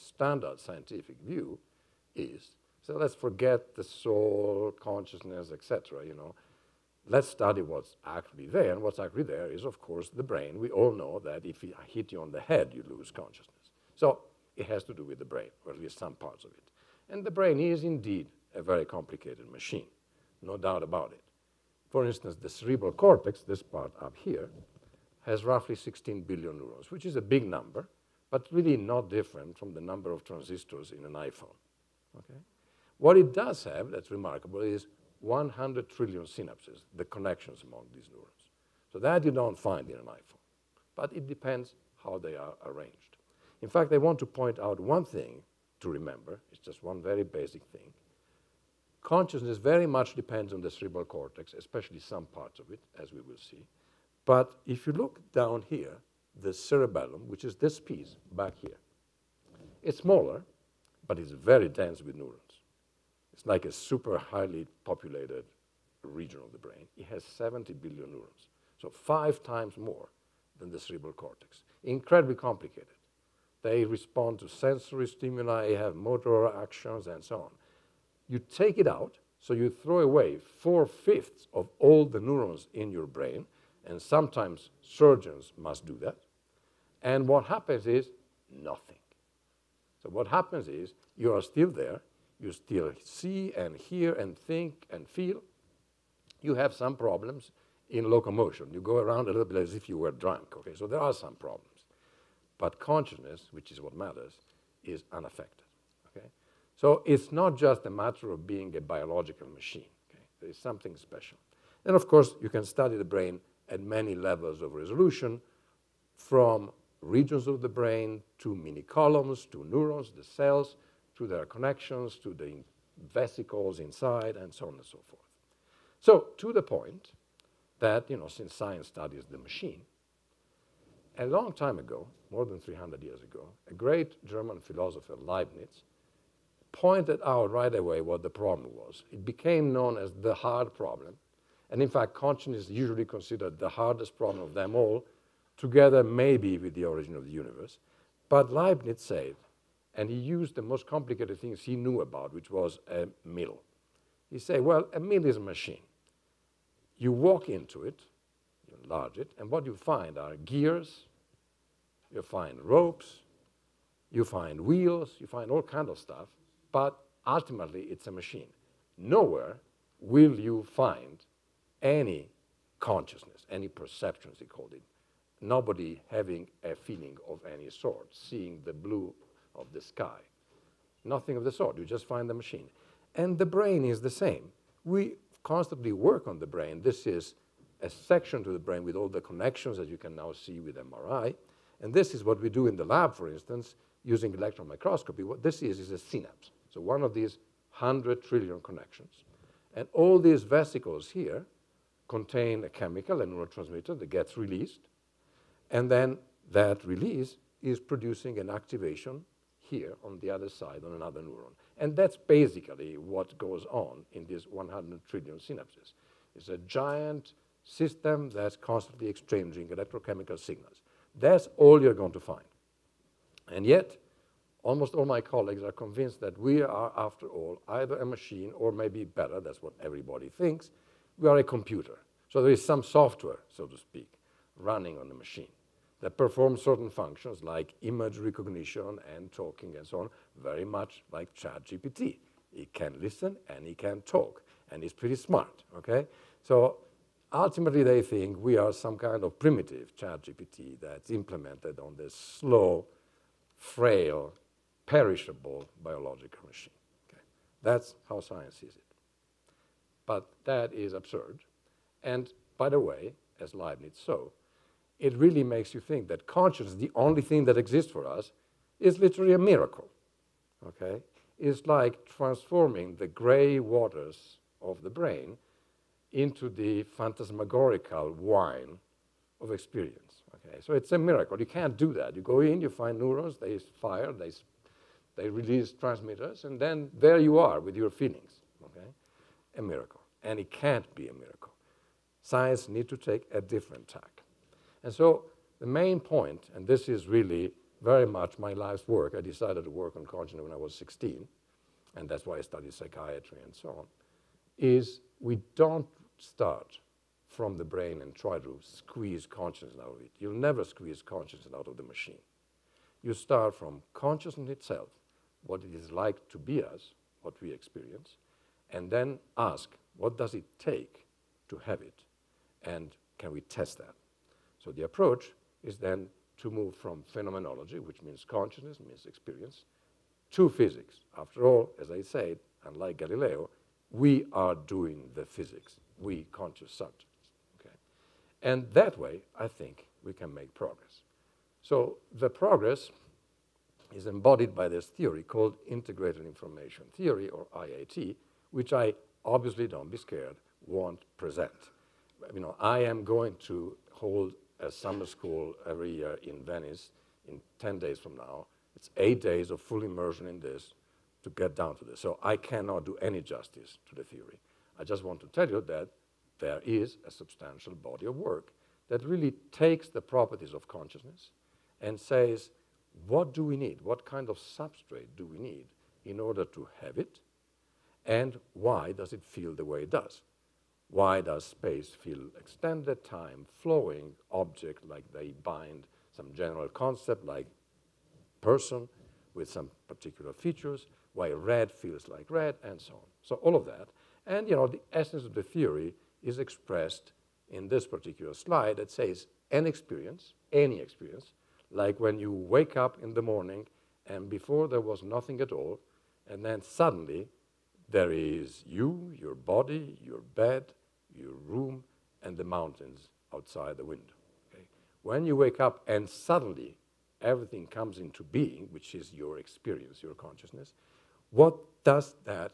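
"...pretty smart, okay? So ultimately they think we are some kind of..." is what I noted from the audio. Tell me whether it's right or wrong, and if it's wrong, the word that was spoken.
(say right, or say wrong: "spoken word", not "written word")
right.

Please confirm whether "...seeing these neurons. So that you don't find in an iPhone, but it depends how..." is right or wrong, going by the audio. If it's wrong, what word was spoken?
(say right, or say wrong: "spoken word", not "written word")
wrong: "among", not "seeing".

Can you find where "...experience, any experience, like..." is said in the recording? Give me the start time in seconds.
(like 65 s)
399 s.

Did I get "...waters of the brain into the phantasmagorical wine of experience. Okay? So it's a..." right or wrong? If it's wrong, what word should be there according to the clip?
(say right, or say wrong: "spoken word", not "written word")
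right.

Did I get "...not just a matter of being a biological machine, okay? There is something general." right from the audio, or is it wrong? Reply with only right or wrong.
wrong.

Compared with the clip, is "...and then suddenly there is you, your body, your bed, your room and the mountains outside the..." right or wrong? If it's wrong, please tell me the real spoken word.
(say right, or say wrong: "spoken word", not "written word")
right.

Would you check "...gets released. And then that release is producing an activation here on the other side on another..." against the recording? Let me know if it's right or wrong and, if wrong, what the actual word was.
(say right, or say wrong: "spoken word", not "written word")
right.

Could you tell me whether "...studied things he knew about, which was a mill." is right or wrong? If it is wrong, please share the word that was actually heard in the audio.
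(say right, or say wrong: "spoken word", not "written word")
wrong: "complicated", not "studied".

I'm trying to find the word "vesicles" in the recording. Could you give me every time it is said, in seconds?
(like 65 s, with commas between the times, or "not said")
123 s, 200 s.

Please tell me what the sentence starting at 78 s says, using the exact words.
You take it out, so you throw away four-fifths of all the neurons in your brain, and sometimes surgeons must do that.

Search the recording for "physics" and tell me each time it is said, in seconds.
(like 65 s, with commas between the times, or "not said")
330 s, 335 s.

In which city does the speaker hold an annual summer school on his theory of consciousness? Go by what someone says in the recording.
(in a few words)
Venice.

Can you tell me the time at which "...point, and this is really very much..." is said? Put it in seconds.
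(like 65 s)
295 s.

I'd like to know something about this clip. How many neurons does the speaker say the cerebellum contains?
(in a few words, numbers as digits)
70 billion.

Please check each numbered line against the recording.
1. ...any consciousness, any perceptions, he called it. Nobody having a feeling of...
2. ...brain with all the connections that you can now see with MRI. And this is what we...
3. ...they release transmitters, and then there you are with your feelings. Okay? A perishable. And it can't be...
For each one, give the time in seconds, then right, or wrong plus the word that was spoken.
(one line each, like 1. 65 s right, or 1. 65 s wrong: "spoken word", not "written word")
1. 171 s right
2. 188 s right
3. 285 s wrong: "miracle", not "perishable".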